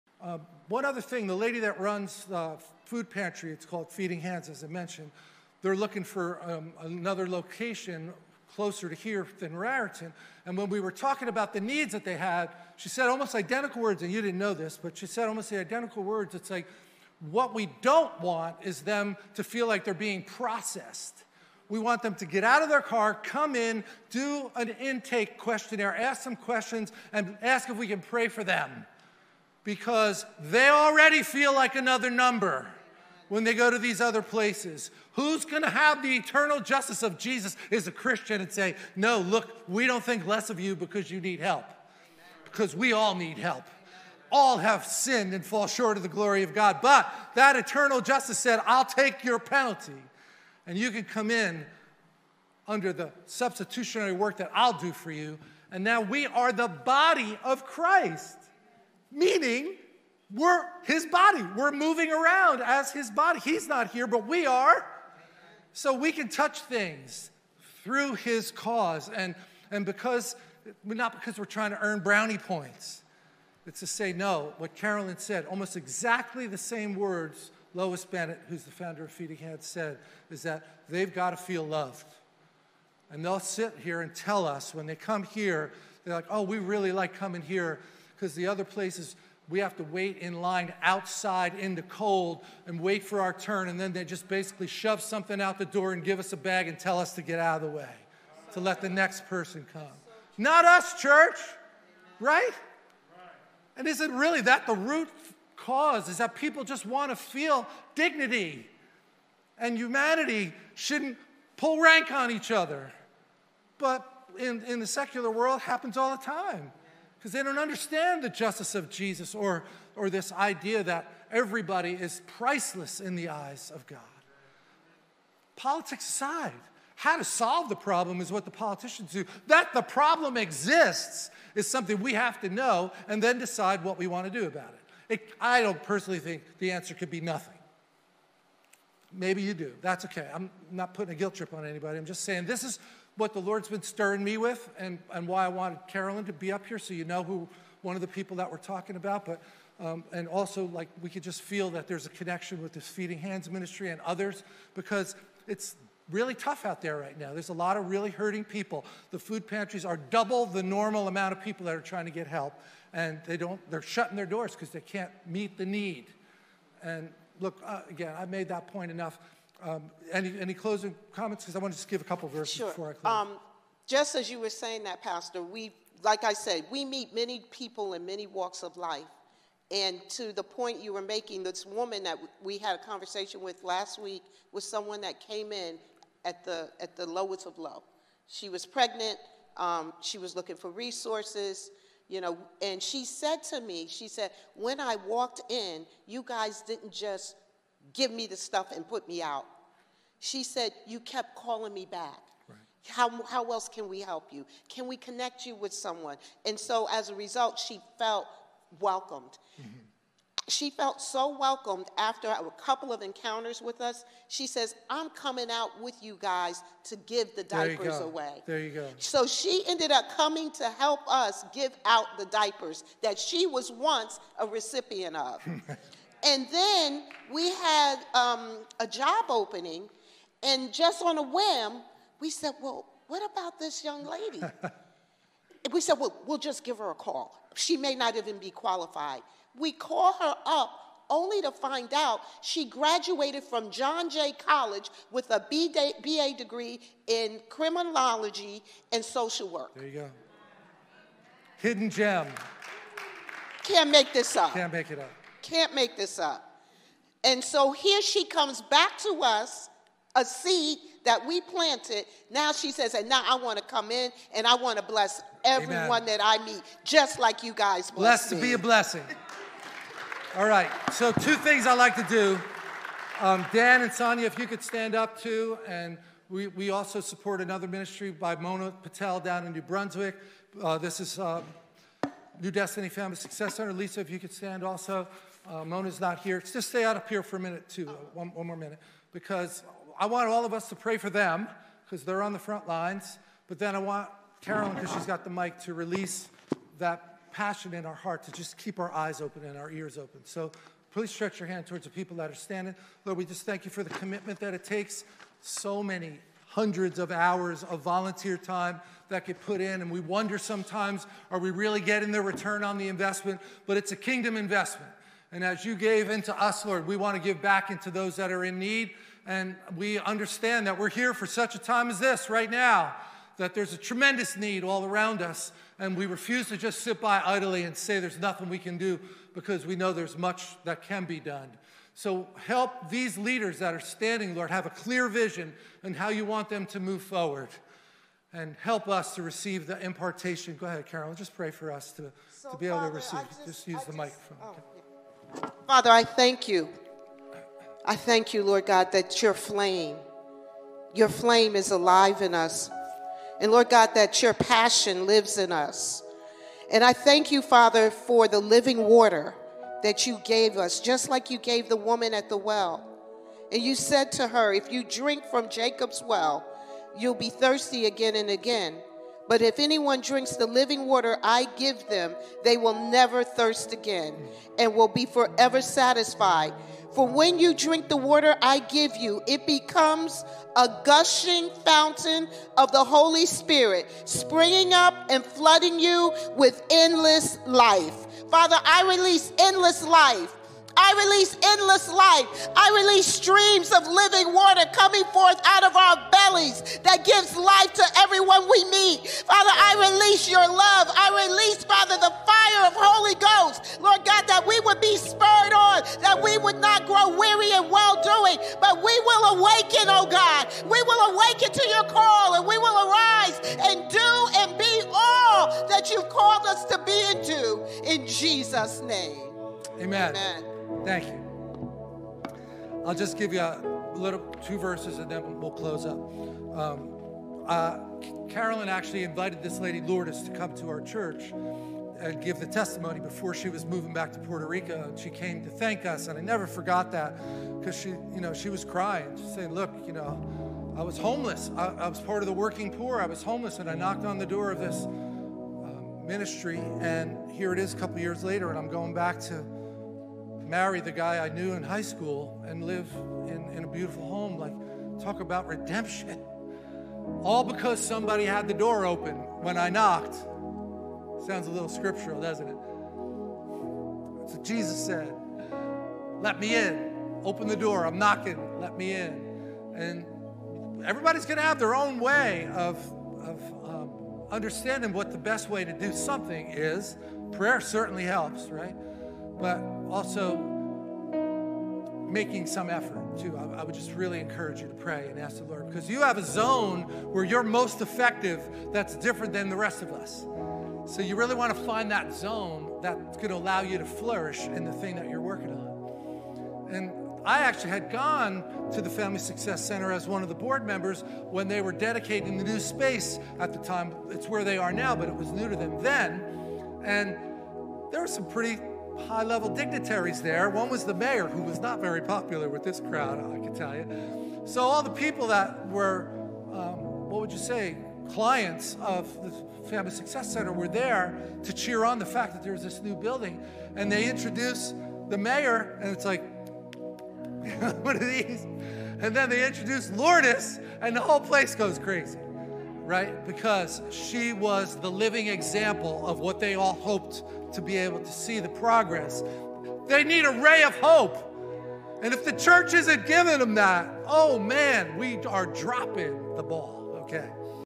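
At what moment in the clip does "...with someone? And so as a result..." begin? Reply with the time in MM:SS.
03:25.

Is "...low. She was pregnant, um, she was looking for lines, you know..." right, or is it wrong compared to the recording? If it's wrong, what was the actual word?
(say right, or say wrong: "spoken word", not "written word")
wrong: "resources", not "lines".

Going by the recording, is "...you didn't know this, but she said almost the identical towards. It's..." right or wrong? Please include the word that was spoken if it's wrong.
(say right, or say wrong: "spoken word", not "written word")
wrong: "words", not "towards".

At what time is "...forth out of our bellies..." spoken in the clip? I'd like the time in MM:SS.
06:35.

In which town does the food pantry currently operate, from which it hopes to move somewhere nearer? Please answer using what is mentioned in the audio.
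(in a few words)
Raritan.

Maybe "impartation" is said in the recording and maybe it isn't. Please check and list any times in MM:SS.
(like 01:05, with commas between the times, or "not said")
05:39.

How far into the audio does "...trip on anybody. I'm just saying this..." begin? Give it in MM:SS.
02:21.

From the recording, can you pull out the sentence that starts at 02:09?
That the problem exists is something we have to know and then decide what we want to do about it.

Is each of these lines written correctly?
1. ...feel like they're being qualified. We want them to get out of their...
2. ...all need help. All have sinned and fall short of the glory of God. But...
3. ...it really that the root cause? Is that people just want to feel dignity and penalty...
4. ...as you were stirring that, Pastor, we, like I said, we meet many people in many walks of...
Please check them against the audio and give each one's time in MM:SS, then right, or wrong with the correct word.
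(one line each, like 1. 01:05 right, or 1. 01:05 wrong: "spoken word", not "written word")
1. 00:19 wrong: "processed", not "qualified"
2. 00:42 right
3. 01:44 wrong: "humanity", not "penalty"
4. 02:54 wrong: "saying", not "stirring".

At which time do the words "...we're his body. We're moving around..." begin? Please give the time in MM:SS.
01:00.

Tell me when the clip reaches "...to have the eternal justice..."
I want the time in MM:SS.
00:35.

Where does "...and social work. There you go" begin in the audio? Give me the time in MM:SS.
04:08.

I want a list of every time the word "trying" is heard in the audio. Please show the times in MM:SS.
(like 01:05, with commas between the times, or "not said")
01:11, 02:41.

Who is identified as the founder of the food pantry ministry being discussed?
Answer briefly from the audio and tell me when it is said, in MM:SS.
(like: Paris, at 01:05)
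Lois Bennett, at 01:17.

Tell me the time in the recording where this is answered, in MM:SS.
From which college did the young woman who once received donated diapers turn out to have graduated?
04:03.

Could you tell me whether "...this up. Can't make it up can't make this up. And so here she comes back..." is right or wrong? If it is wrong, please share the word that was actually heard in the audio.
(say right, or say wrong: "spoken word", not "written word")
right.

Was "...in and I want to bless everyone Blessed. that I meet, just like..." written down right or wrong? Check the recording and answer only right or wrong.
wrong.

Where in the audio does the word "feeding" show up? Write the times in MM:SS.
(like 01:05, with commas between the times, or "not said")
00:03, 01:19, 02:32.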